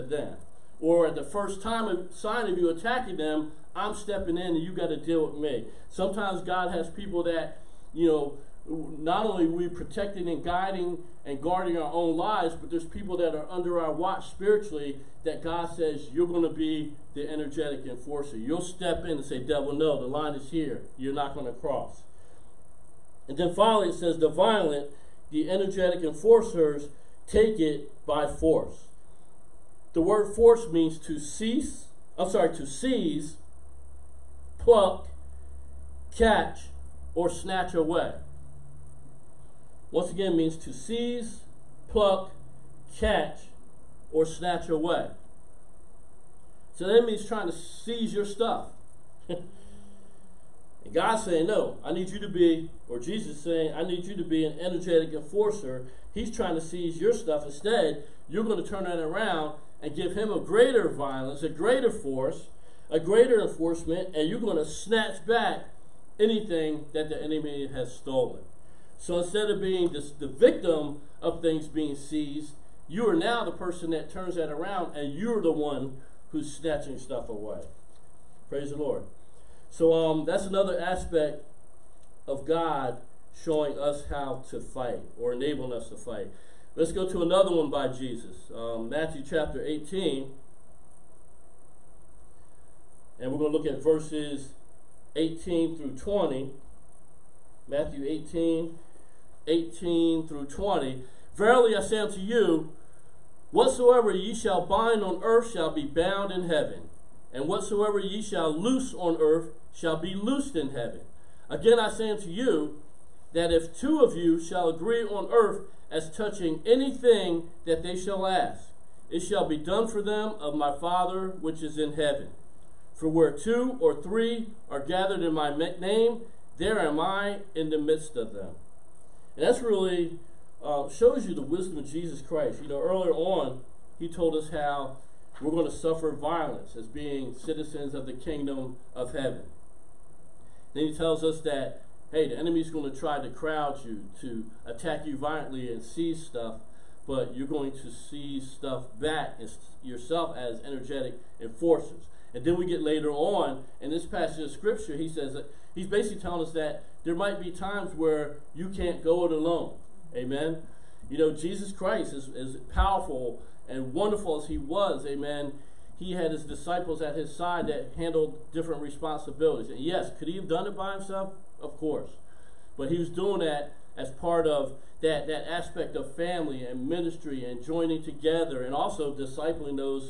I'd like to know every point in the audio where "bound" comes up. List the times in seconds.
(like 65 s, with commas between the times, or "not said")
105 s.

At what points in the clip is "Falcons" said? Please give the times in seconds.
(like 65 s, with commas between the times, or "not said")
not said.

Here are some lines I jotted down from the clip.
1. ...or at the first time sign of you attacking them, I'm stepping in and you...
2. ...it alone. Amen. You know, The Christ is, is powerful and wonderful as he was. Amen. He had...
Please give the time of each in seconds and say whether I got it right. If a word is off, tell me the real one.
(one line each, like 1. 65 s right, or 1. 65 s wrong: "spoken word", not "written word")
1. 0 s right
2. 159 s wrong: "Jesus", not "The".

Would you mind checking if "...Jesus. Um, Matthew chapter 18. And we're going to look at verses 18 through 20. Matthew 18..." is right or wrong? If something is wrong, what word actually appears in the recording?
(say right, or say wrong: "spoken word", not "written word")
right.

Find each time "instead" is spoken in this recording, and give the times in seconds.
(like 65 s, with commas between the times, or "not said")
57 s, 69 s.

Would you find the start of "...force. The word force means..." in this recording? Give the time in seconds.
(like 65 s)
28 s.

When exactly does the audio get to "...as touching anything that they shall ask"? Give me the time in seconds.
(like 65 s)
115 s.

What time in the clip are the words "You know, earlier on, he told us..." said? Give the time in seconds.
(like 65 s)
132 s.